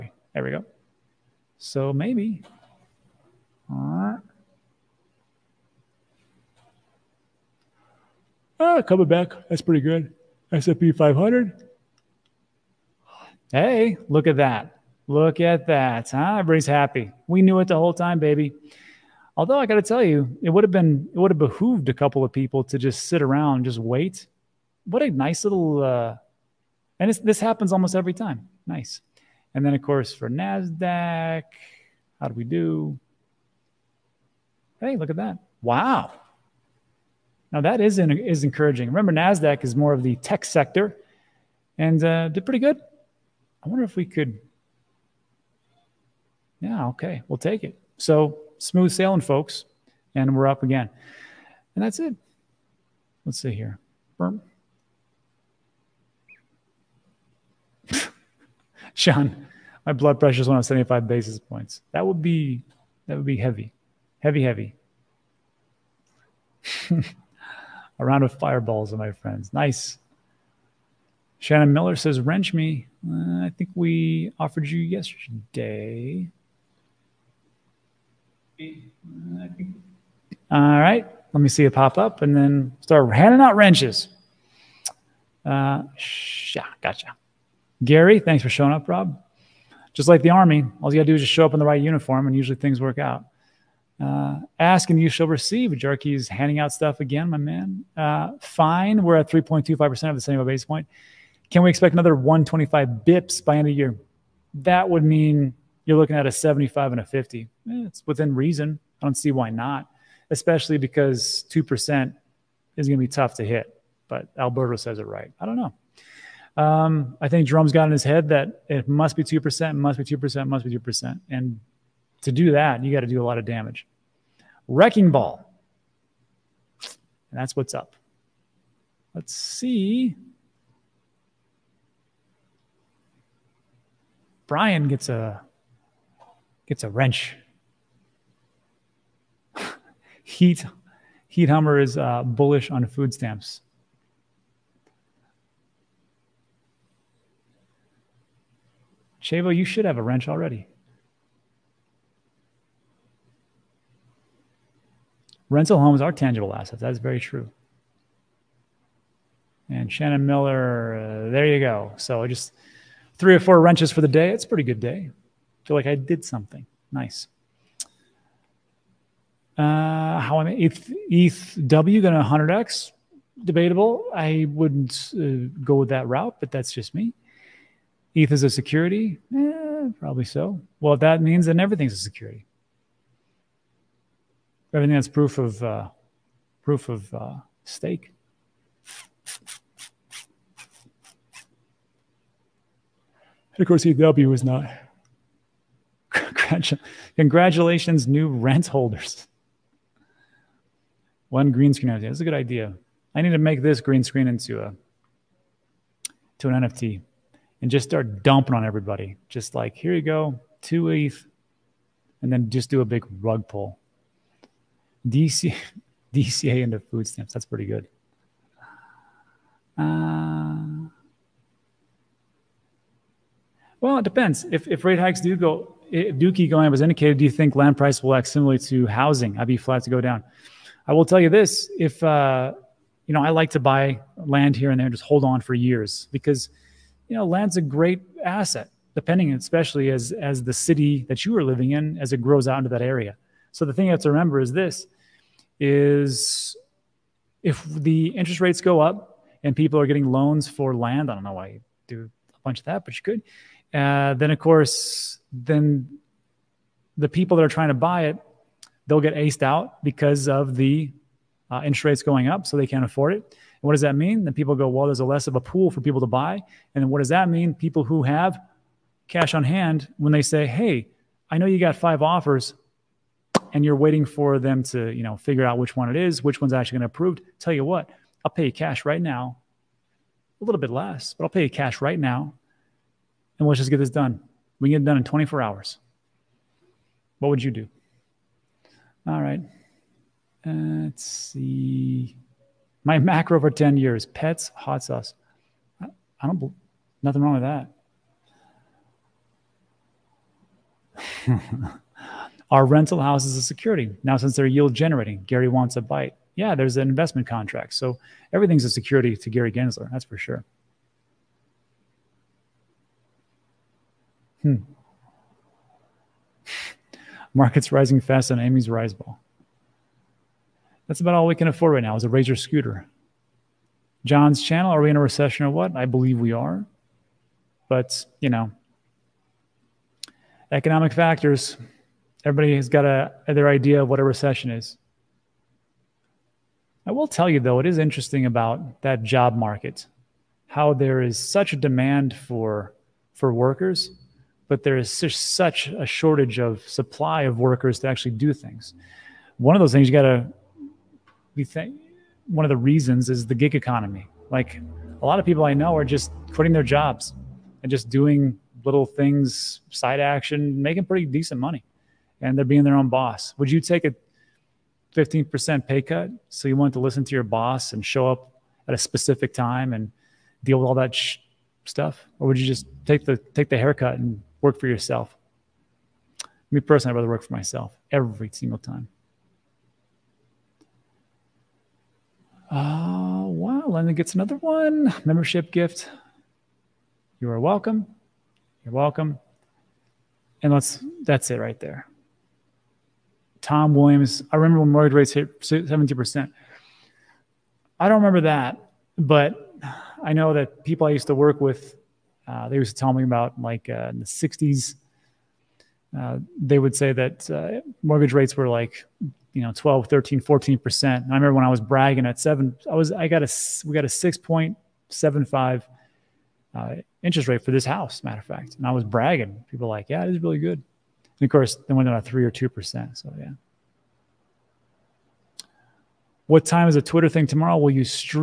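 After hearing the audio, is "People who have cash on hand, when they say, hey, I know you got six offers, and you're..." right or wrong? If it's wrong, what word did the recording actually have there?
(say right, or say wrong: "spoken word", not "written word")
wrong: "five", not "six".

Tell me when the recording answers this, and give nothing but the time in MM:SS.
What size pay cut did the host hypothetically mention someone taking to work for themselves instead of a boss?
06:04.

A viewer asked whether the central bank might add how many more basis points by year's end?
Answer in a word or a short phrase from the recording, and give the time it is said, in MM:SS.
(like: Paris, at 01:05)
125, at 01:42.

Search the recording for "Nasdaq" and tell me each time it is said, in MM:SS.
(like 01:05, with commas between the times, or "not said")
00:30, 00:39.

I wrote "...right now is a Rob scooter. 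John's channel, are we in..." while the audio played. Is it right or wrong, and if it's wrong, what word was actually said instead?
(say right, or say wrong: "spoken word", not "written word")
wrong: "Razor", not "Rob".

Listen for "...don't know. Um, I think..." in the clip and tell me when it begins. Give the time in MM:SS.
01:55.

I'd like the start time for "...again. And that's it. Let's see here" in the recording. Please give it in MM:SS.
00:50.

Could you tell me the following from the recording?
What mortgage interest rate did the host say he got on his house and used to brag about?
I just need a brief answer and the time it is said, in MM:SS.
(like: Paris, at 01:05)
6.75%, at 06:53.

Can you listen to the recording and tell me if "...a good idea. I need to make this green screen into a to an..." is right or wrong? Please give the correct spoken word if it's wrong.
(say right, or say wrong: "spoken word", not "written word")
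right.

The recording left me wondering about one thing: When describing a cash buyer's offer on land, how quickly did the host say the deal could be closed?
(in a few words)
24 hours.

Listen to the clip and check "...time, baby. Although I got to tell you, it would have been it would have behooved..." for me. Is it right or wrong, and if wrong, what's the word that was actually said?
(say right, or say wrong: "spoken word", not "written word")
right.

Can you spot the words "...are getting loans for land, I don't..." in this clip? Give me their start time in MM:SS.
04:09.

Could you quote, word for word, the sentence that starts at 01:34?
Uh, ask and you shall receive.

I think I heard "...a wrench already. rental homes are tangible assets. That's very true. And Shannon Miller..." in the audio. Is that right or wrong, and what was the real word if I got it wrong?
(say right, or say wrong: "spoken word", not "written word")
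right.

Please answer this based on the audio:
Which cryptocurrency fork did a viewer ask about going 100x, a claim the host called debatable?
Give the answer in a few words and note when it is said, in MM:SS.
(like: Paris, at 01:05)
ETH W, at 02:51.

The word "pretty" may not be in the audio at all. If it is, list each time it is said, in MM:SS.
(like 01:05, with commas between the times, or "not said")
00:09, 00:42, 02:44, 03:37, 06:00.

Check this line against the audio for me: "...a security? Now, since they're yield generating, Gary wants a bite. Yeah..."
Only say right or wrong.
right.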